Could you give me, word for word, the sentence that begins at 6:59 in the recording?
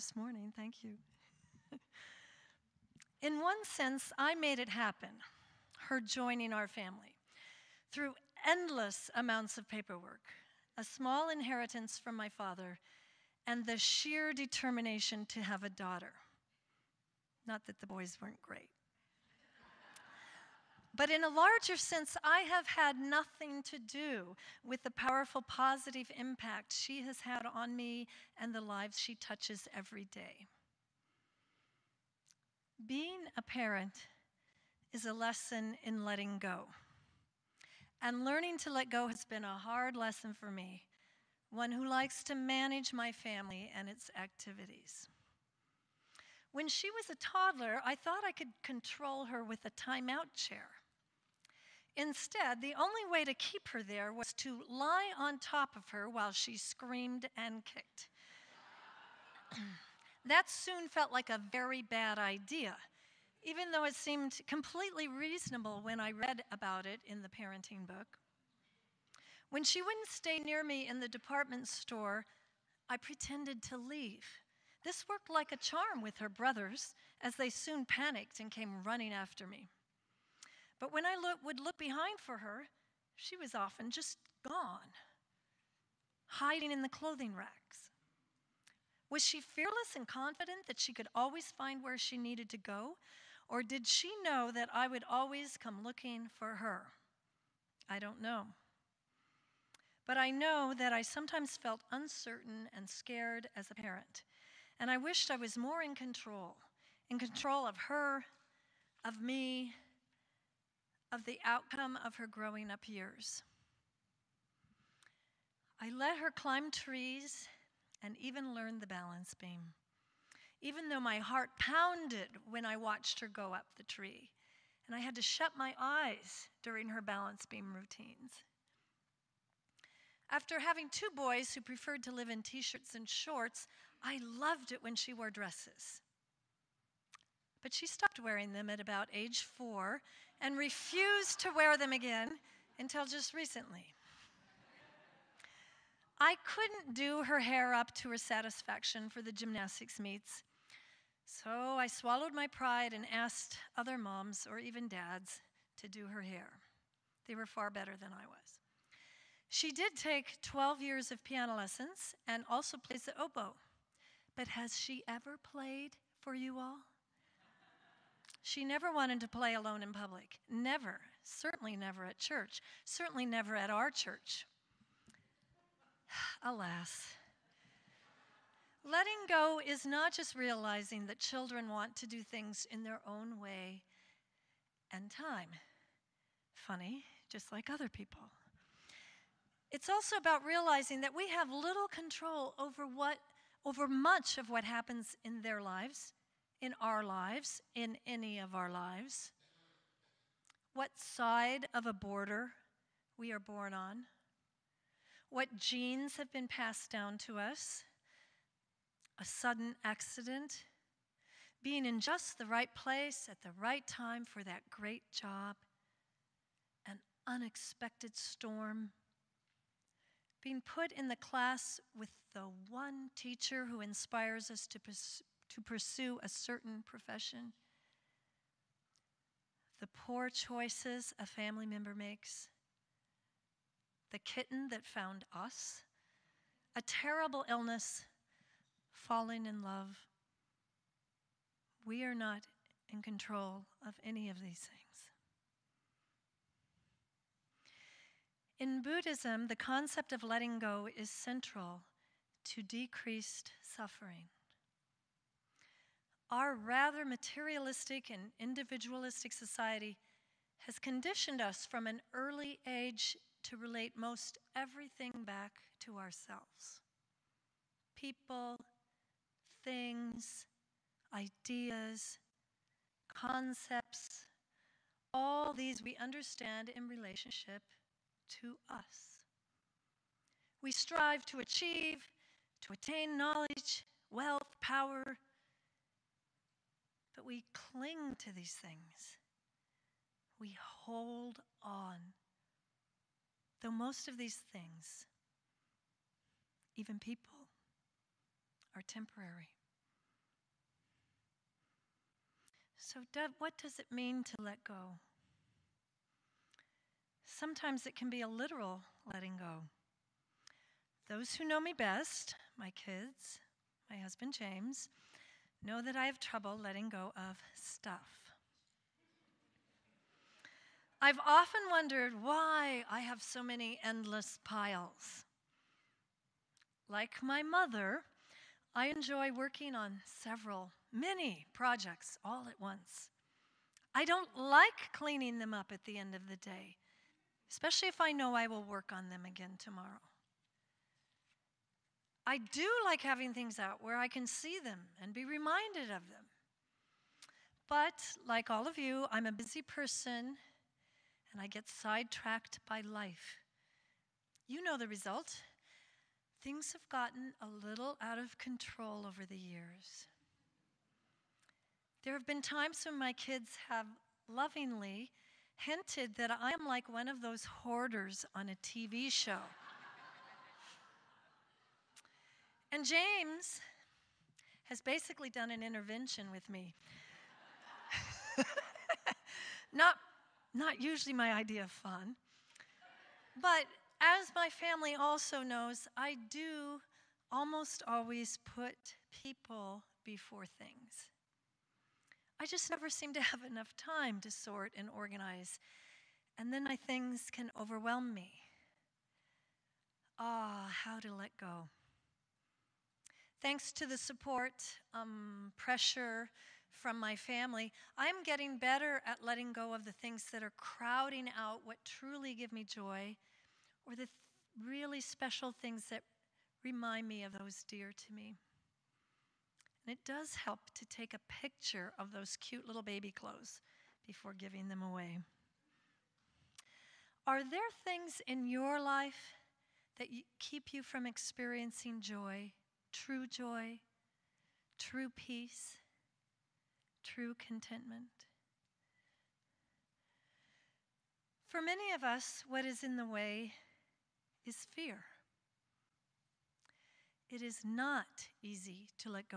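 And it does help to take a picture of those cute little baby clothes before giving them away.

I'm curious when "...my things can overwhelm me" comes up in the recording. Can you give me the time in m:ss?
6:36.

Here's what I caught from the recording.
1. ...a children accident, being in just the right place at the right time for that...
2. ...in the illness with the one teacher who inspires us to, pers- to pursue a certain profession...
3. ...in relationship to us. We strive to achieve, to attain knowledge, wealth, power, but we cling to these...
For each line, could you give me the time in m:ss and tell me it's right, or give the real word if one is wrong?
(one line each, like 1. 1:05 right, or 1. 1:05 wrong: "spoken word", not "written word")
1. 3:29 wrong: "sudden", not "children"
2. 3:40 wrong: "class", not "illness"
3. 4:36 right.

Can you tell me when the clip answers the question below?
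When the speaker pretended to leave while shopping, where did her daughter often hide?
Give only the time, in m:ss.
1:26.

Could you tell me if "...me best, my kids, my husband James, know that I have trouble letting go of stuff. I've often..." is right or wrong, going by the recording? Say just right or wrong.
right.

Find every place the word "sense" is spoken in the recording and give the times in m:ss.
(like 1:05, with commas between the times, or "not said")
0:03, 0:21.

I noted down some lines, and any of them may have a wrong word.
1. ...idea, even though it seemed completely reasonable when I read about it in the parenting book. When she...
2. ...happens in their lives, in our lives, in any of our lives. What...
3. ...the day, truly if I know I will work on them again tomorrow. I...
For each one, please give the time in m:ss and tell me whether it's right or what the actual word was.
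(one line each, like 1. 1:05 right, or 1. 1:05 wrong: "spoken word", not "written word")
1. 1:02 right
2. 3:14 right
3. 5:36 wrong: "especially", not "truly".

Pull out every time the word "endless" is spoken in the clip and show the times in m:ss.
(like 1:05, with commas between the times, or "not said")
0:08, 5:23.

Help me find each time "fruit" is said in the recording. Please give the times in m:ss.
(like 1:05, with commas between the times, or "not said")
not said.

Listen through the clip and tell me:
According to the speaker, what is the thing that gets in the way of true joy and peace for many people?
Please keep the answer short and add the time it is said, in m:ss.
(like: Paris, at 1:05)
Fear, at 7:24.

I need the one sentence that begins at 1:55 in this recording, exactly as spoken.
I let her climb trees and even learned the balance beam.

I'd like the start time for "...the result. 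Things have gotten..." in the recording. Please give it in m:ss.
5:54.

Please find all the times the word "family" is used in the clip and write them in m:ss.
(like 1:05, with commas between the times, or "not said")
0:06, 0:43, 3:51, 6:24, 6:47.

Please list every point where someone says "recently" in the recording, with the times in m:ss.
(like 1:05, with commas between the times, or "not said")
2:23.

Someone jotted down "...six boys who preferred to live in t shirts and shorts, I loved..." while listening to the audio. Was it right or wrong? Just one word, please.
wrong.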